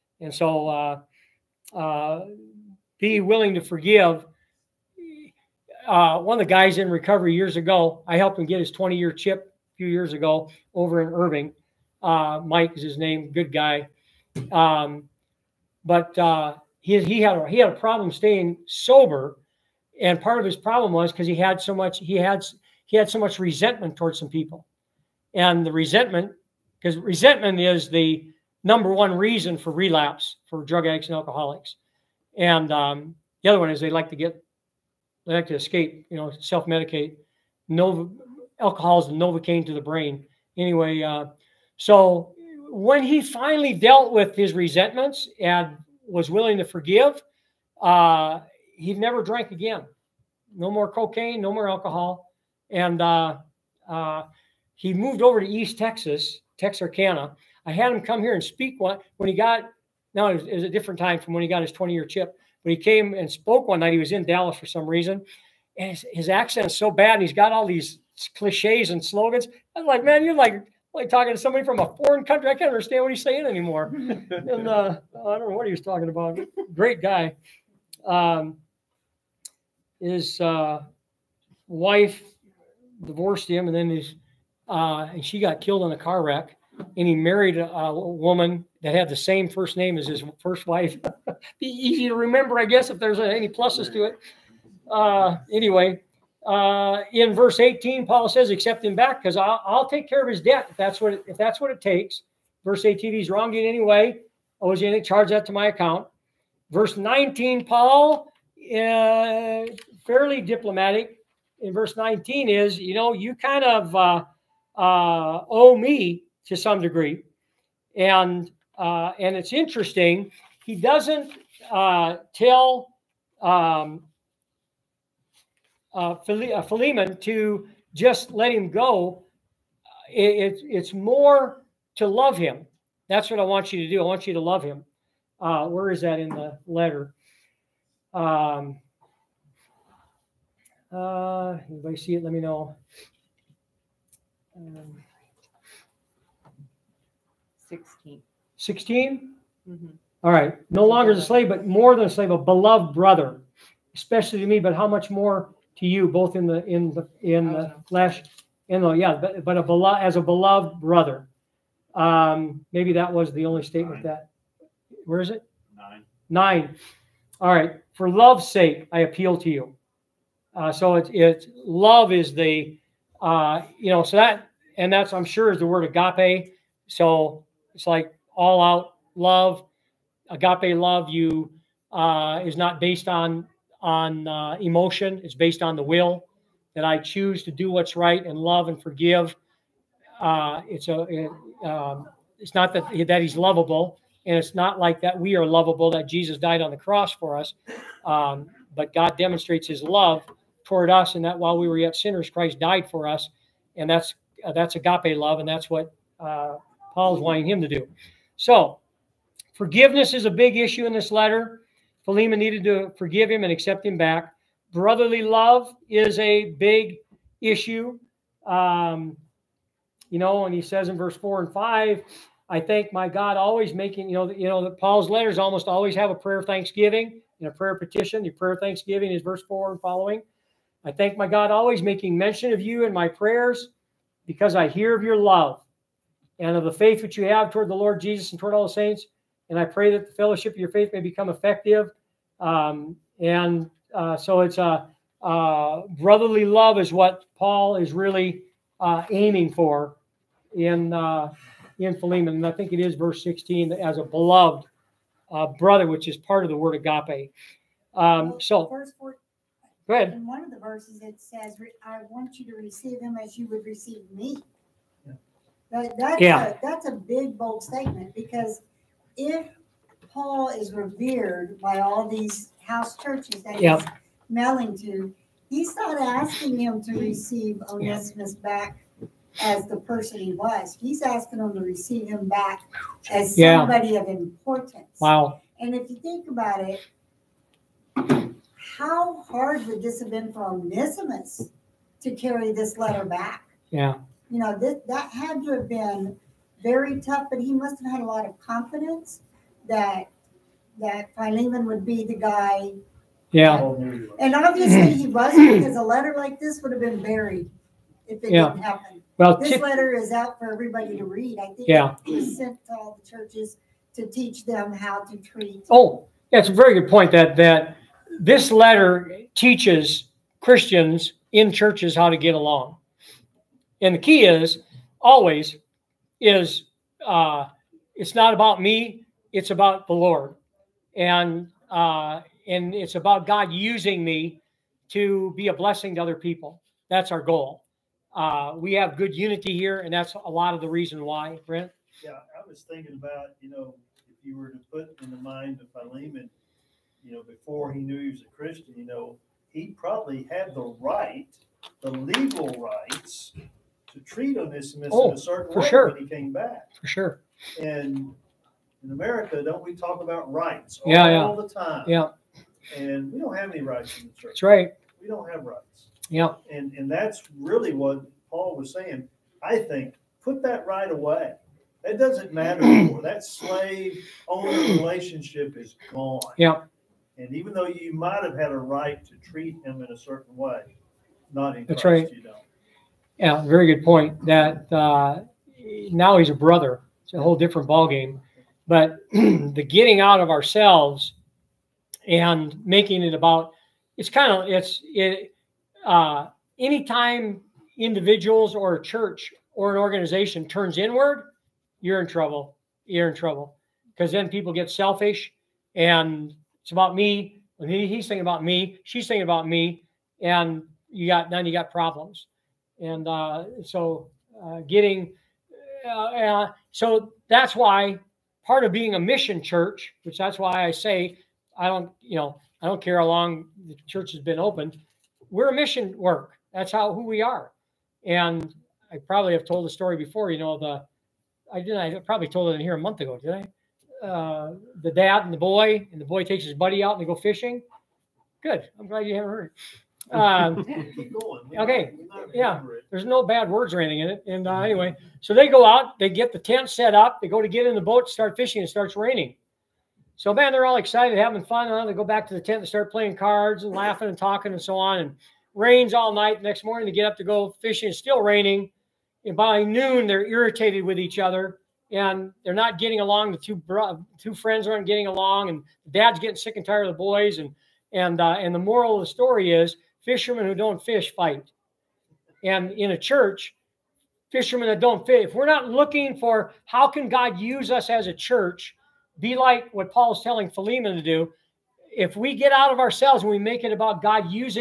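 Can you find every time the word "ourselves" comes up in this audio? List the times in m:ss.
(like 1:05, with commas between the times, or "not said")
6:30, 8:02.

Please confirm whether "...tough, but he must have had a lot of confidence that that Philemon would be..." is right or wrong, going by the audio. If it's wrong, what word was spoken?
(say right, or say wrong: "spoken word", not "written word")
right.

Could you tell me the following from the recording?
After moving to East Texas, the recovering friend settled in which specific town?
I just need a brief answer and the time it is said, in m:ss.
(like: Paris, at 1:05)
Texarkana, at 0:56.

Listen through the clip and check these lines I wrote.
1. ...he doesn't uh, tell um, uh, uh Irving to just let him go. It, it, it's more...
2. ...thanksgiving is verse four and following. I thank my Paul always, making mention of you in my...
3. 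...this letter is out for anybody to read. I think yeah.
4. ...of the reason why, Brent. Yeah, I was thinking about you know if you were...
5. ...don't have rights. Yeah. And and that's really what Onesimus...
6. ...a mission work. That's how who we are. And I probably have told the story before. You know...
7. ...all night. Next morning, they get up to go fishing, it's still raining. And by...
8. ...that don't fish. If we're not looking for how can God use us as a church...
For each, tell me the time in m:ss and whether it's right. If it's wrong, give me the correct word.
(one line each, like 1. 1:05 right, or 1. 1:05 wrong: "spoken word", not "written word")
1. 2:00 wrong: "Philemon", not "Irving"
2. 3:48 wrong: "God", not "Paul"
3. 5:09 wrong: "everybody", not "anybody"
4. 5:40 right
5. 6:05 wrong: "Paul", not "Onesimus"
6. 7:05 right
7. 7:35 right
8. 7:54 right.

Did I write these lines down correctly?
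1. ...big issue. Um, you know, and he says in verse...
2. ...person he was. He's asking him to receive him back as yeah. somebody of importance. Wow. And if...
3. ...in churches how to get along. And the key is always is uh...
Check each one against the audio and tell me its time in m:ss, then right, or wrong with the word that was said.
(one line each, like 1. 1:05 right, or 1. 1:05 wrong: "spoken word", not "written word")
1. 3:36 right
2. 4:39 right
3. 5:21 right.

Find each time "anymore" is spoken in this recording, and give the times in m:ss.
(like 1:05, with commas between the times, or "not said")
1:13, 6:12.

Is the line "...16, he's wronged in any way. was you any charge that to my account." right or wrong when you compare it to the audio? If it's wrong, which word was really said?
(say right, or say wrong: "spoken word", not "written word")
wrong: "18", not "16".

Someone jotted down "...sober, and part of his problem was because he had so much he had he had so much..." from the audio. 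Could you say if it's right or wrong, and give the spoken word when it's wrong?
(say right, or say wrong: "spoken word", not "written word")
right.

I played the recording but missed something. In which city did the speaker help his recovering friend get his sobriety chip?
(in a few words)
Irving.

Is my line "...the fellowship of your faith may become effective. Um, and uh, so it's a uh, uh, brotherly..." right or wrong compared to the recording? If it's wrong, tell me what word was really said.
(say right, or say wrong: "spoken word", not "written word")
right.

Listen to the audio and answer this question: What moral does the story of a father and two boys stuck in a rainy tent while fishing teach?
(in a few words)
Fishermen who don't fish fight.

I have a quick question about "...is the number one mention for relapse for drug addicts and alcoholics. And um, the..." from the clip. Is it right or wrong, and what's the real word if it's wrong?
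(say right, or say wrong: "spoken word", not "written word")
wrong: "reason", not "mention".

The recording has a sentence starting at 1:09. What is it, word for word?
I am like, man, you're like like talking to somebody from a foreign country.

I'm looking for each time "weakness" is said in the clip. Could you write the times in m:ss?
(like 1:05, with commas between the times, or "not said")
not said.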